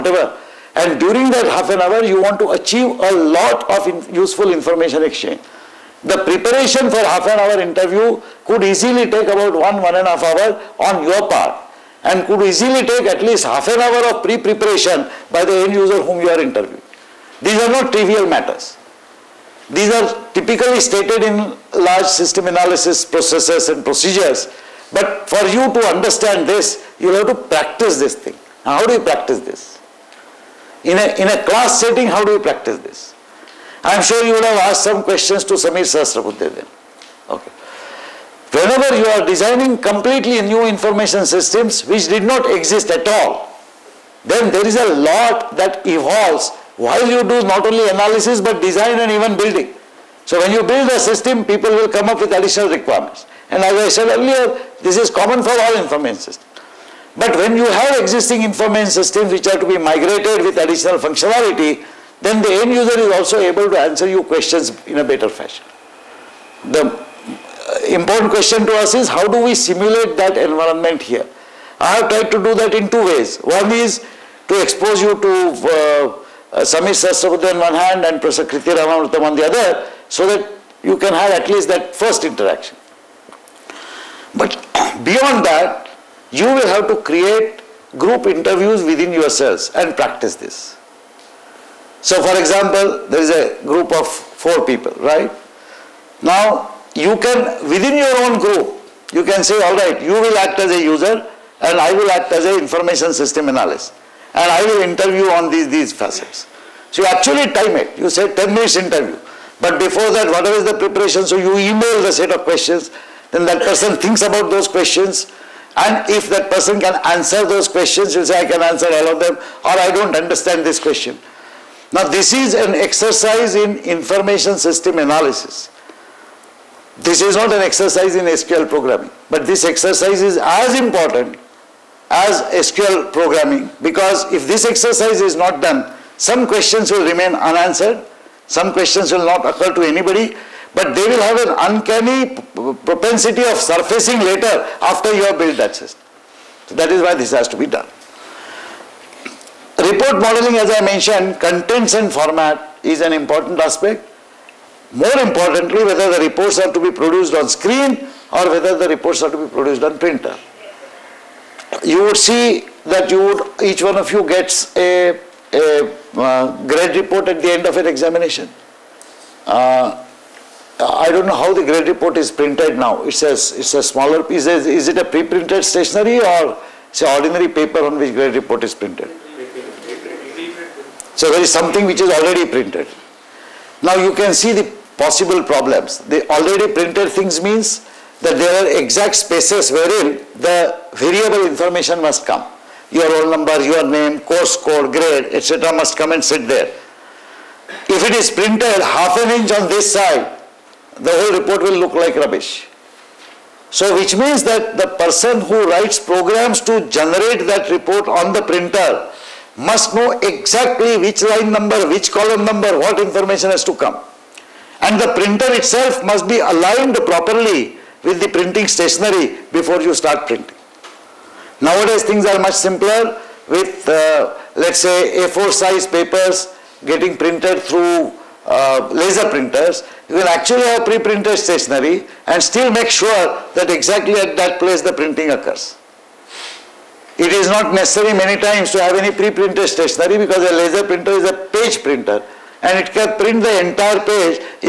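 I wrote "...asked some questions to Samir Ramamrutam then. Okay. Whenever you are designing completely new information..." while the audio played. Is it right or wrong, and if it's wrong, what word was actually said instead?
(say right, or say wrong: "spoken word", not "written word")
wrong: "Sasraputte", not "Ramamrutam".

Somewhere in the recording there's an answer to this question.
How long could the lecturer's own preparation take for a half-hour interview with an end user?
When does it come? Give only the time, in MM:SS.
00:09.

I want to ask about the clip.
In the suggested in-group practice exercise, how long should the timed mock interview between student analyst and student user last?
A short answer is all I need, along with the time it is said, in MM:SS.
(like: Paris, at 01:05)
10 minutes, at 01:48.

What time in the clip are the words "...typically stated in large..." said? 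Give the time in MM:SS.
00:20.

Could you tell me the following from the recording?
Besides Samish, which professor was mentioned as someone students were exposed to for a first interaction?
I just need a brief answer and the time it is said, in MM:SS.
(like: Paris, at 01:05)
Kriti Ramamrutam, at 01:18.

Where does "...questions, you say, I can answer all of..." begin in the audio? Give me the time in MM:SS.
01:57.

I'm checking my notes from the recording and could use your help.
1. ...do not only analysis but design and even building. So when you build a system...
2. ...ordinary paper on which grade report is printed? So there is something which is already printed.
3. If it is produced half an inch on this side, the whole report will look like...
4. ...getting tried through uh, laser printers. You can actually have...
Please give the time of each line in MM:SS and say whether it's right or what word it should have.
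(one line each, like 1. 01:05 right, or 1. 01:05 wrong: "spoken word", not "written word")
1. 00:47 right
2. 02:57 right
3. 03:17 wrong: "printed", not "produced"
4. 03:46 wrong: "printed", not "tried".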